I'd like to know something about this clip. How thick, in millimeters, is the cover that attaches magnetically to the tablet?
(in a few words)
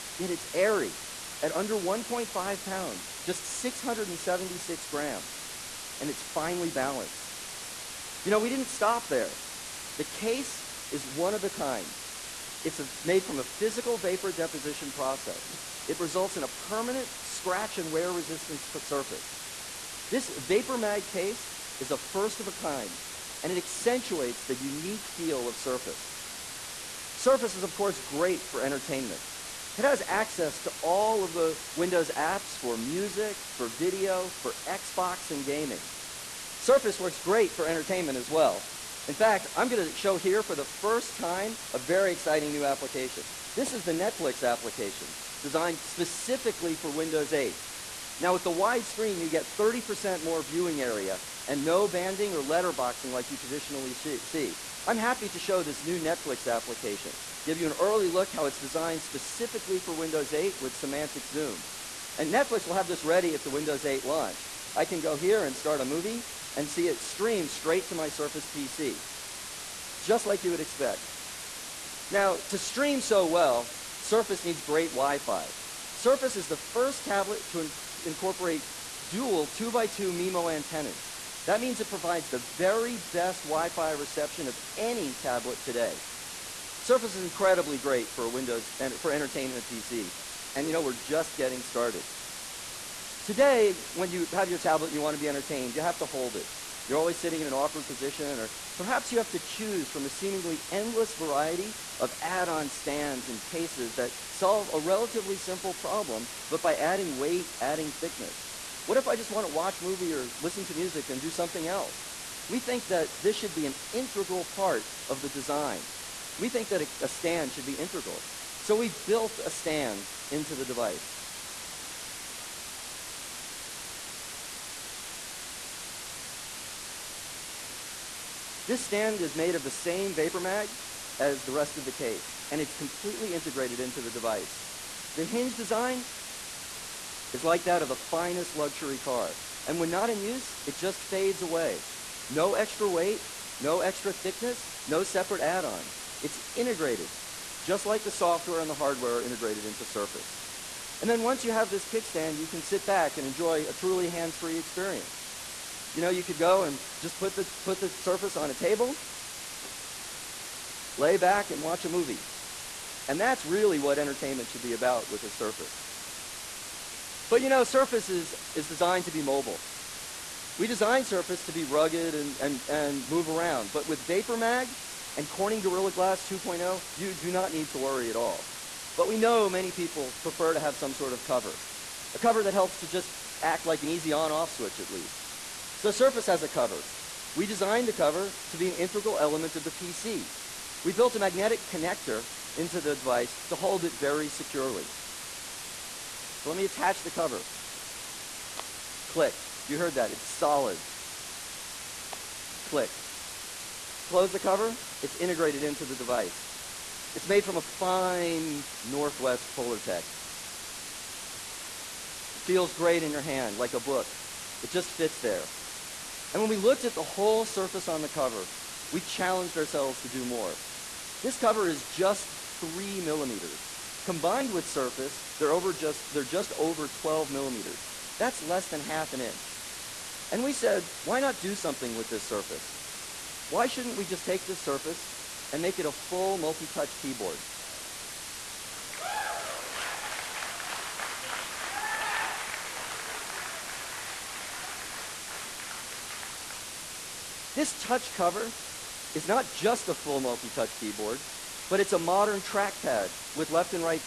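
3 millimeters.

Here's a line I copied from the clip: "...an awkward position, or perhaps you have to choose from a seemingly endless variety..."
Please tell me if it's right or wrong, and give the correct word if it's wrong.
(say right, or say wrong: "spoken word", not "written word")
right.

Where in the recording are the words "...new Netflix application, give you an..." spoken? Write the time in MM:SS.
00:55.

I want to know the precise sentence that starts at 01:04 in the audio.
I can go here and start a movie and see it stream straight to my Surface PC, just like you would expect.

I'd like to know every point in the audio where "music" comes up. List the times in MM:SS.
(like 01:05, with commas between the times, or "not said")
00:32, 01:50.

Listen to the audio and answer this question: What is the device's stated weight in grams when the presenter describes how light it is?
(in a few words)
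676 grams.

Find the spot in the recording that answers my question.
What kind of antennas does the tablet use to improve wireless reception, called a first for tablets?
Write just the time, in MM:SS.
01:19.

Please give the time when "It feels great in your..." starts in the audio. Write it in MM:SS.
03:32.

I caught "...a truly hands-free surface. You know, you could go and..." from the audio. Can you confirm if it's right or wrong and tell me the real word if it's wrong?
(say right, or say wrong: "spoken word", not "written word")
wrong: "experience", not "surface".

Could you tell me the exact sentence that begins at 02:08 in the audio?
This stand is made of the same vapor mag as the rest of the case, and it's completely integrated into the device.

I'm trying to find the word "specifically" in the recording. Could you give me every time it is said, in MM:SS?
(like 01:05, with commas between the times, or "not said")
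00:45, 00:59.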